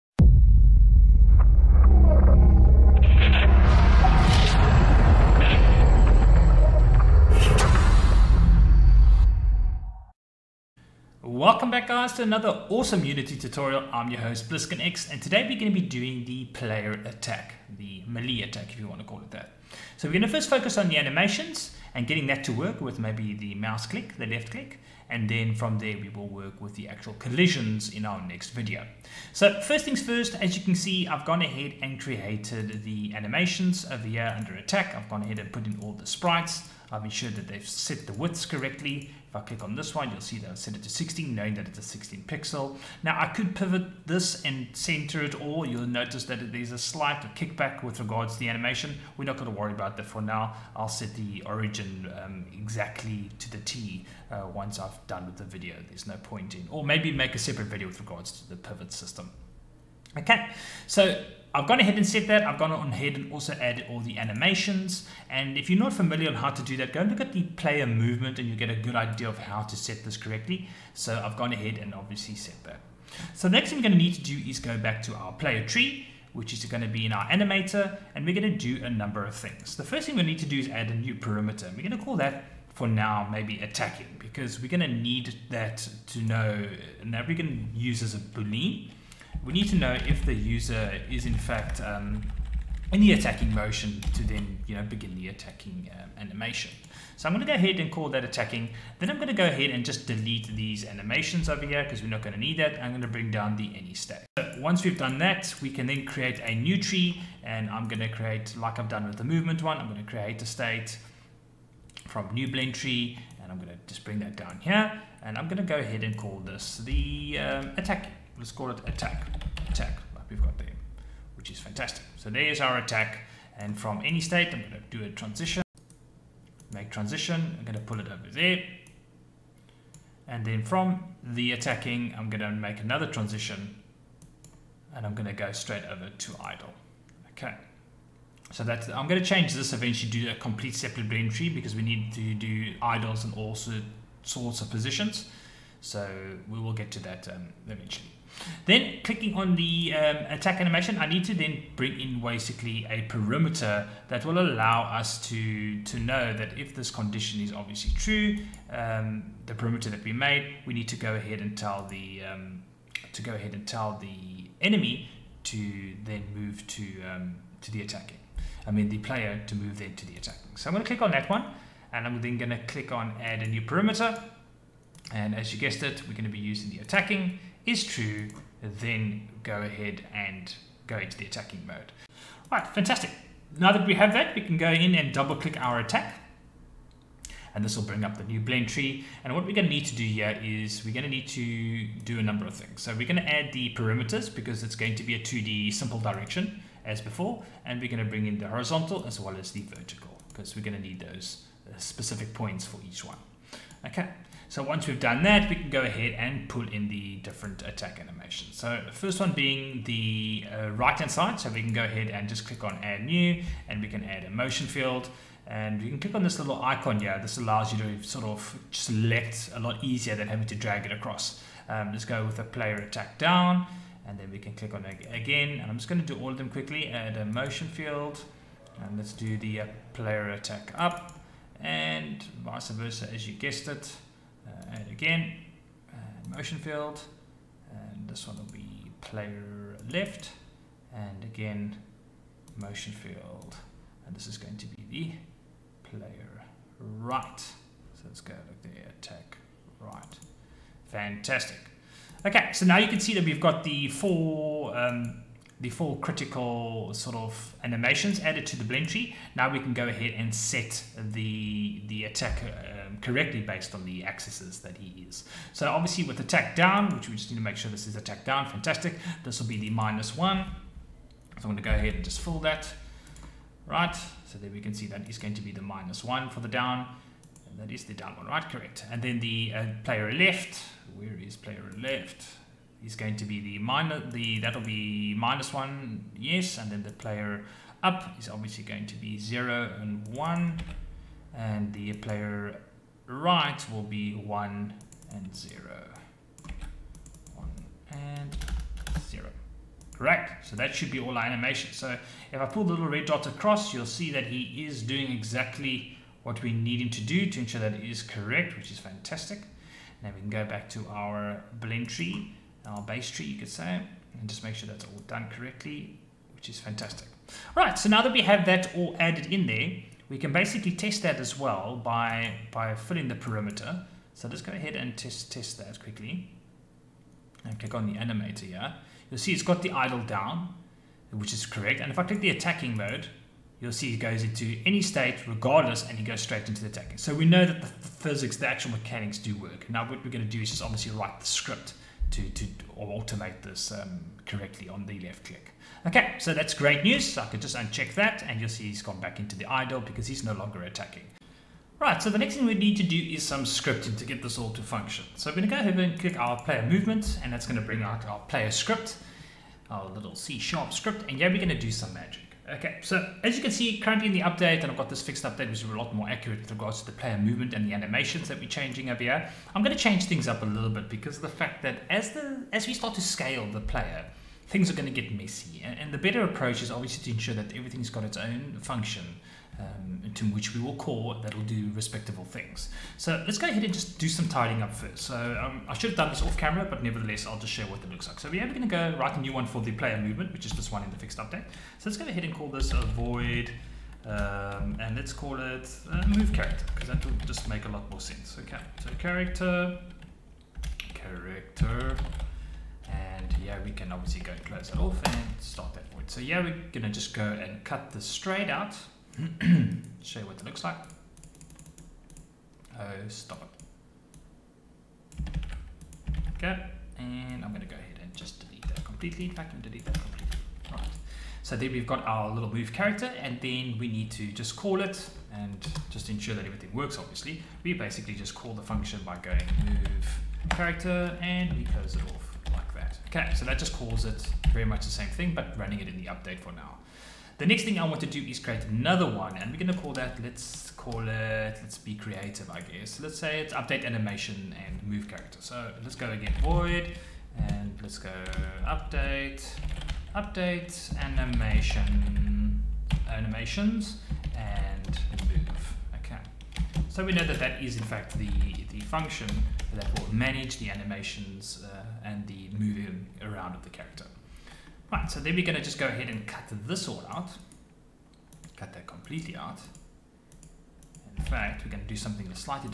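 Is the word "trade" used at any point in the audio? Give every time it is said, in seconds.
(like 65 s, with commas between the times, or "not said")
not said.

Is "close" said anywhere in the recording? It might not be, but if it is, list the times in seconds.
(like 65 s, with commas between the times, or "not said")
404 s, 431 s.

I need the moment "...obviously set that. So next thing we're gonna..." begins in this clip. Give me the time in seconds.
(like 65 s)
71 s.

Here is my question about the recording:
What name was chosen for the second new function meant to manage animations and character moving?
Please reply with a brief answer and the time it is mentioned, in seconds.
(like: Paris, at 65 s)
update animation and move, at 450 s.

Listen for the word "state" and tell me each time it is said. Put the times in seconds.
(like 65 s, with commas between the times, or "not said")
103 s, 110 s, 124 s, 334 s.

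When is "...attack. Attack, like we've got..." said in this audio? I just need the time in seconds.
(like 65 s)
118 s.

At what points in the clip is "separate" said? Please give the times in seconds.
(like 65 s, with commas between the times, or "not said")
57 s, 140 s.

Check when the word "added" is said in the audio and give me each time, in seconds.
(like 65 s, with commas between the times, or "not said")
63 s, 258 s, 319 s.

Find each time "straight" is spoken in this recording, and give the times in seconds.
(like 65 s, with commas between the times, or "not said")
135 s, 336 s, 408 s.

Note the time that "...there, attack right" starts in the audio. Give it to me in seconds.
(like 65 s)
248 s.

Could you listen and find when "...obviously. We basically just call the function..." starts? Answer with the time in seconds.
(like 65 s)
426 s.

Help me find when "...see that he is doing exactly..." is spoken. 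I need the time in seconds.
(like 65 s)
303 s.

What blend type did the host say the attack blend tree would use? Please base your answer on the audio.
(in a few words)
2D simple direction.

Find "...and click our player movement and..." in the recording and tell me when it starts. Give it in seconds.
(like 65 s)
355 s.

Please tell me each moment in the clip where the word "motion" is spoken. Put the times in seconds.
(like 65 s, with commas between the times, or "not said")
93 s, 214 s, 227 s, 236 s, 242 s.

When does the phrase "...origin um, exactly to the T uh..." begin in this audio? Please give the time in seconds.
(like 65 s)
51 s.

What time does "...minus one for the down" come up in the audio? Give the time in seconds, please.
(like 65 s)
275 s.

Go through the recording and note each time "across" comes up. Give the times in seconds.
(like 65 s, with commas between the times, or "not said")
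220 s, 303 s.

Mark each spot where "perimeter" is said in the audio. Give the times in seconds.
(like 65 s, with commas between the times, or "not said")
81 s, 153 s, 159 s, 173 s, 193 s, 323 s.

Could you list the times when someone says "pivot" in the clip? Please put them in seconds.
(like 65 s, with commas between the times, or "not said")
43 s, 58 s.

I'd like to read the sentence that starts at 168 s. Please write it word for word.
I mean the player to move then to the attacking.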